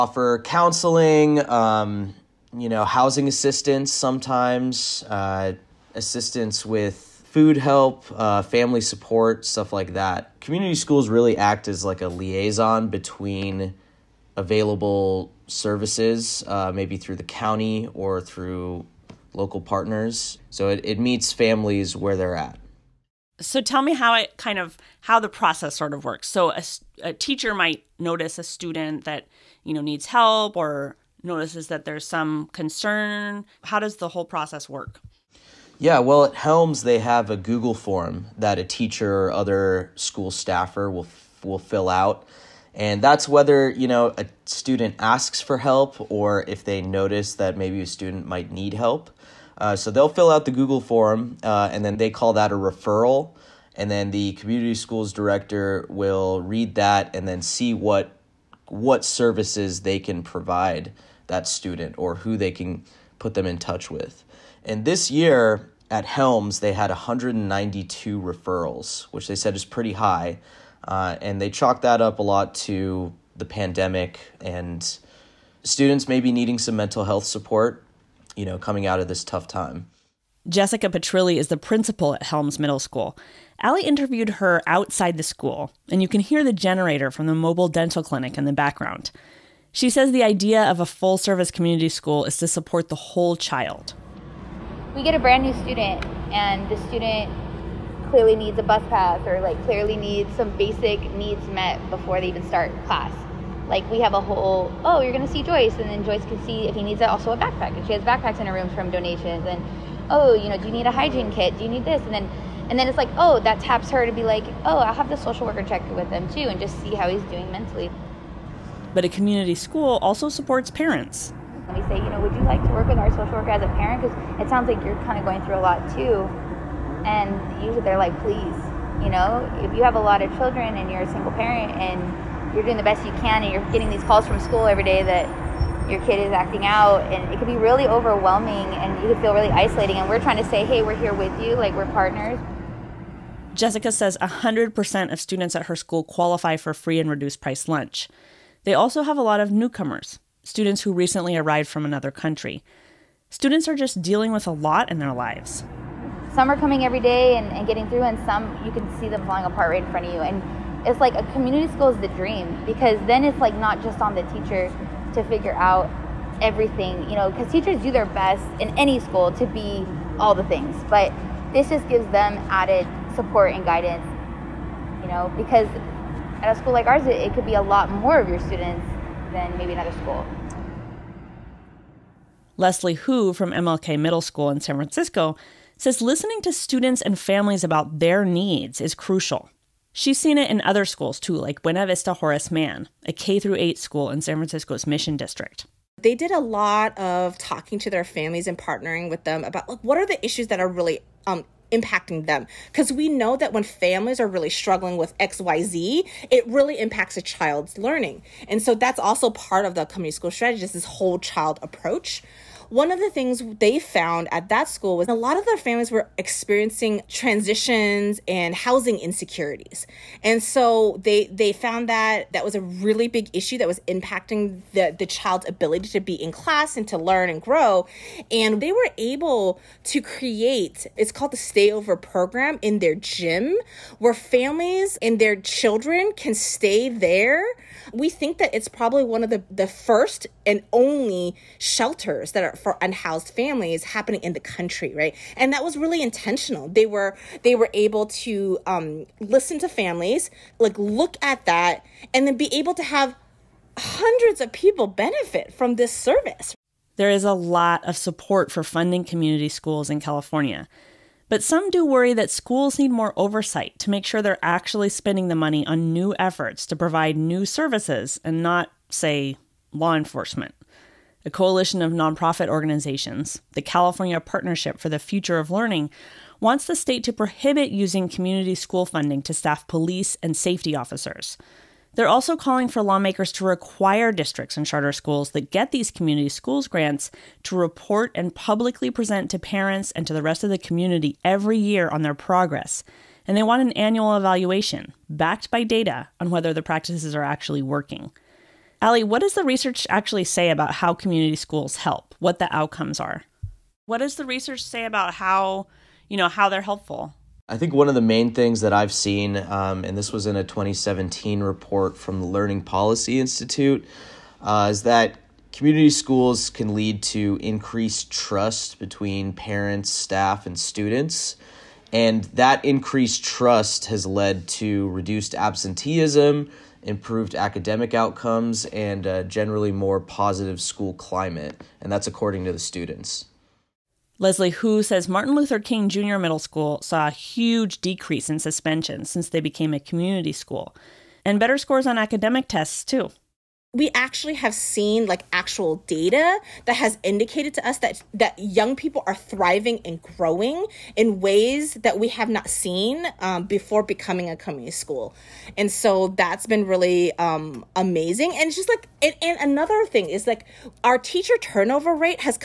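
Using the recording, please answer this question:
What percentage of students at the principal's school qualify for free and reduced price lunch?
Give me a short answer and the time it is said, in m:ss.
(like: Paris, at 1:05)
100%, at 2:24.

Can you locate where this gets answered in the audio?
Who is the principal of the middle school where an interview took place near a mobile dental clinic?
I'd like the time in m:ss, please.
1:20.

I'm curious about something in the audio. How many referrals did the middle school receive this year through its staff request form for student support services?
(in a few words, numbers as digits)
192.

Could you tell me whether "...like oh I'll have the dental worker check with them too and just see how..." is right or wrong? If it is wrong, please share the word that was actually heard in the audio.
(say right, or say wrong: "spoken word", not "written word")
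wrong: "social", not "dental".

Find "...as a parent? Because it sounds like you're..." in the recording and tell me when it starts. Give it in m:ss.
2:03.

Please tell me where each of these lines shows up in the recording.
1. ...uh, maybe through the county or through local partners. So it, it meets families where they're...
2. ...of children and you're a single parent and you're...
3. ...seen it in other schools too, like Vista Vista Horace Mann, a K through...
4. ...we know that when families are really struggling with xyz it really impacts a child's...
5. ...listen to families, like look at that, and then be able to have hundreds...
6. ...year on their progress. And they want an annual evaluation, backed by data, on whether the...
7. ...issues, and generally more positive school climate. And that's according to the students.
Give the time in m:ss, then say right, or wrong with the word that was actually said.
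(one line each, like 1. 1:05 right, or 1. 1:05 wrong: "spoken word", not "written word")
1. 0:16 right
2. 2:10 right
3. 3:10 wrong: "Buena", not "Vista"
4. 3:22 right
5. 4:09 right
6. 4:51 right
7. 5:27 wrong: "outcomes", not "issues".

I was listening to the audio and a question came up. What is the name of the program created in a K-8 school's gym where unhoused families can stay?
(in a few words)
Stayover program.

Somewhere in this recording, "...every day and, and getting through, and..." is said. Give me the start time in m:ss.
2:36.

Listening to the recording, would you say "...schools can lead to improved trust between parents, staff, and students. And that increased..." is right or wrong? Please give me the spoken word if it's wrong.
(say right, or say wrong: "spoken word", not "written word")
wrong: "increased", not "improved".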